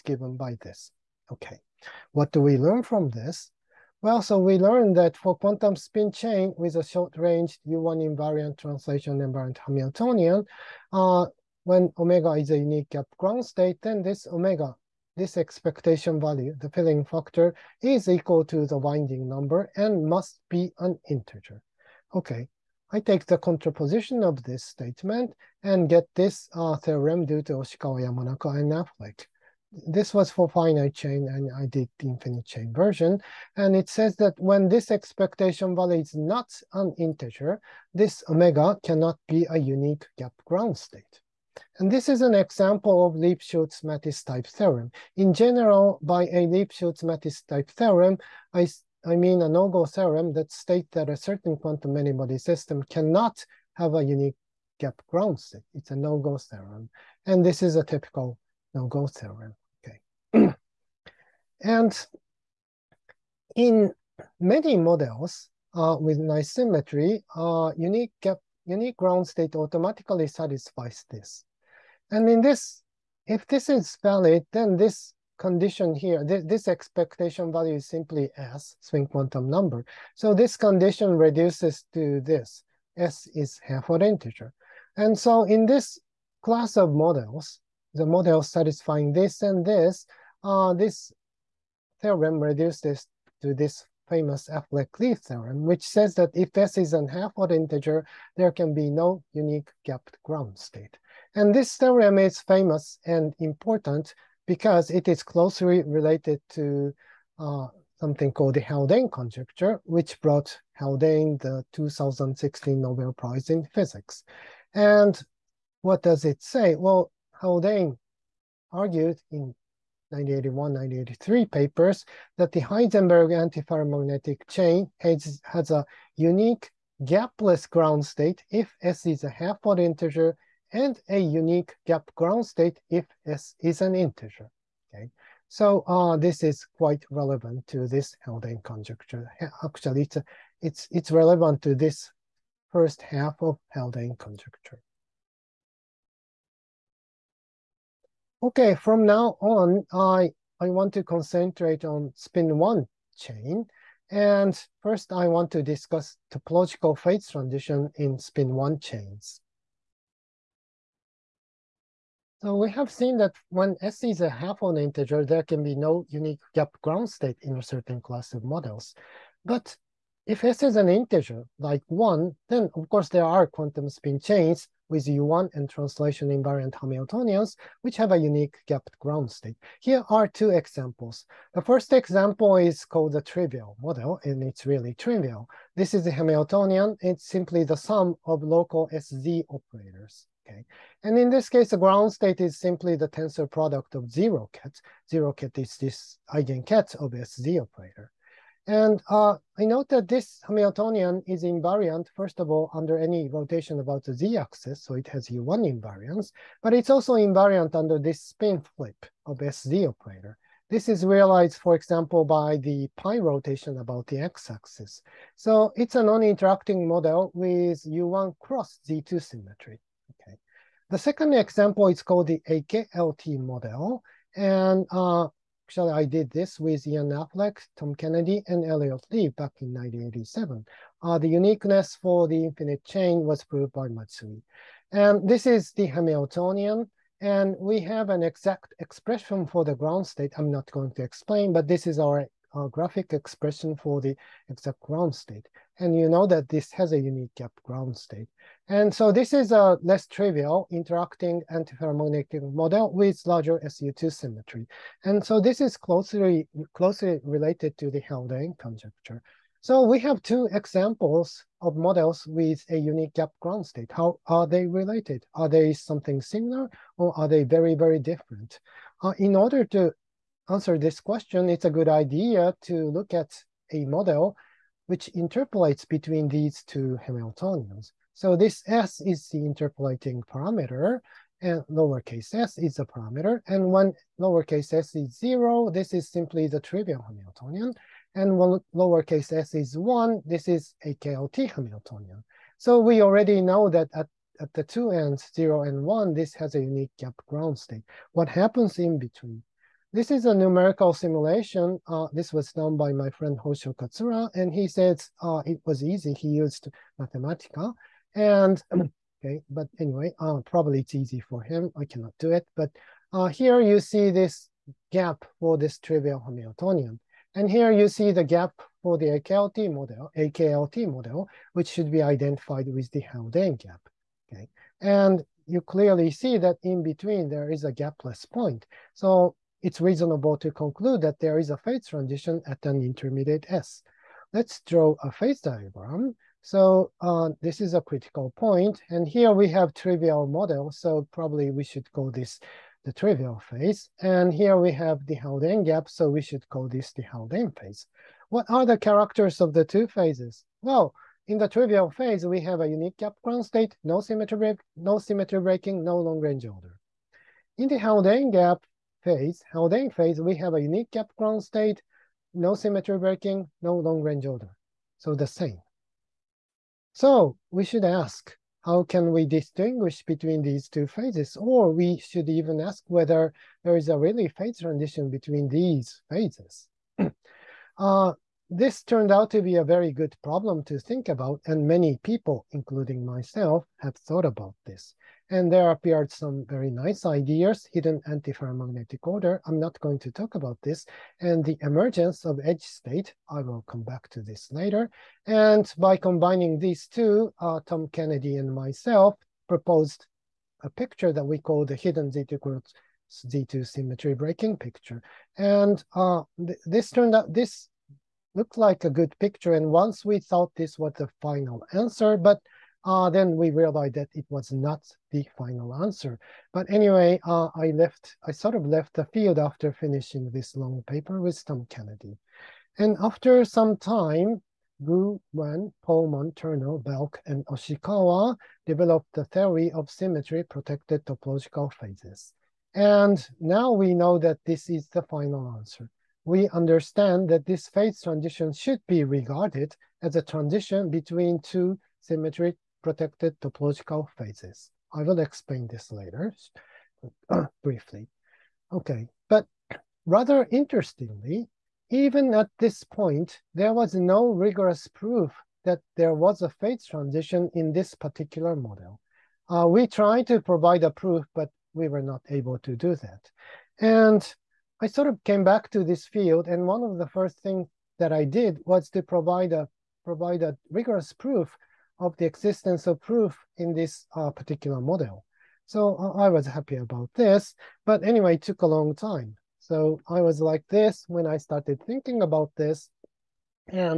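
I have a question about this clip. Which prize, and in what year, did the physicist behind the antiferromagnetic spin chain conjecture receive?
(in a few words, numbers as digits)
2016 Nobel Prize in Physics.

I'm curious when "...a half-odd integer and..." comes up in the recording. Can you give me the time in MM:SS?
02:09.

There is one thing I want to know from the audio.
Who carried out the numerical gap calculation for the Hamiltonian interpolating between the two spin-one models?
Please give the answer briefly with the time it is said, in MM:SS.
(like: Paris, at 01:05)
Hosho Katsura, at 05:03.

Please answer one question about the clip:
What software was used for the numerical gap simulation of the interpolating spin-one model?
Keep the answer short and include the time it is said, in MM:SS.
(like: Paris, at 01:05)
Mathematica, at 05:06.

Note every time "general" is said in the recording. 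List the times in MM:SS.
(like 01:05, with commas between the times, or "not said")
00:45.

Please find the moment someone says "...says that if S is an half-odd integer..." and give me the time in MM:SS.
01:35.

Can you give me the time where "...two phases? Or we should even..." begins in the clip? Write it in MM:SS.
06:10.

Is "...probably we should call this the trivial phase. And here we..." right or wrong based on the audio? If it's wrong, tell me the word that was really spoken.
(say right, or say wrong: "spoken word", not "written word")
right.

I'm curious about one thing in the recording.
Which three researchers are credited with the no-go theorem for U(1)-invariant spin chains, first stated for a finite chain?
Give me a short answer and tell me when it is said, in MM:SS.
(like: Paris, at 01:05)
Oshikawa, Yamanaka, and Affleck, at 00:27.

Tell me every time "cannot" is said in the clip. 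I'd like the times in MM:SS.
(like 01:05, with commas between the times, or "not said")
00:38, 00:52, 05:11.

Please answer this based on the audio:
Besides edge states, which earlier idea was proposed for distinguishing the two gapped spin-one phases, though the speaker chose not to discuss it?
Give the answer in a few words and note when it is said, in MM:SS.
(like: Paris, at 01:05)
hidden antiferromagnetic order, at 06:27.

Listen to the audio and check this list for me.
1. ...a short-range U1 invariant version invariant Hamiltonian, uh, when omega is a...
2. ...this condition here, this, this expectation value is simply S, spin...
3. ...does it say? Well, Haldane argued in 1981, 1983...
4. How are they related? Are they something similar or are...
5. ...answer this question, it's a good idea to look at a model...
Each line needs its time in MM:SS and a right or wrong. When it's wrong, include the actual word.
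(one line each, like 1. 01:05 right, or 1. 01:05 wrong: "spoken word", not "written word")
1. 00:06 wrong: "translation", not "version"
2. 01:14 right
3. 01:56 right
4. 04:23 right
5. 04:30 right.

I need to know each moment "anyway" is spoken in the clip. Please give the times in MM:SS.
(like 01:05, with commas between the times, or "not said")
05:09, 06:56, 07:58.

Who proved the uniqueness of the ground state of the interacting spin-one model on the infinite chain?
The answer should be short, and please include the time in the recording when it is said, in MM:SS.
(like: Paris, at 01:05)
Matsui, at 03:53.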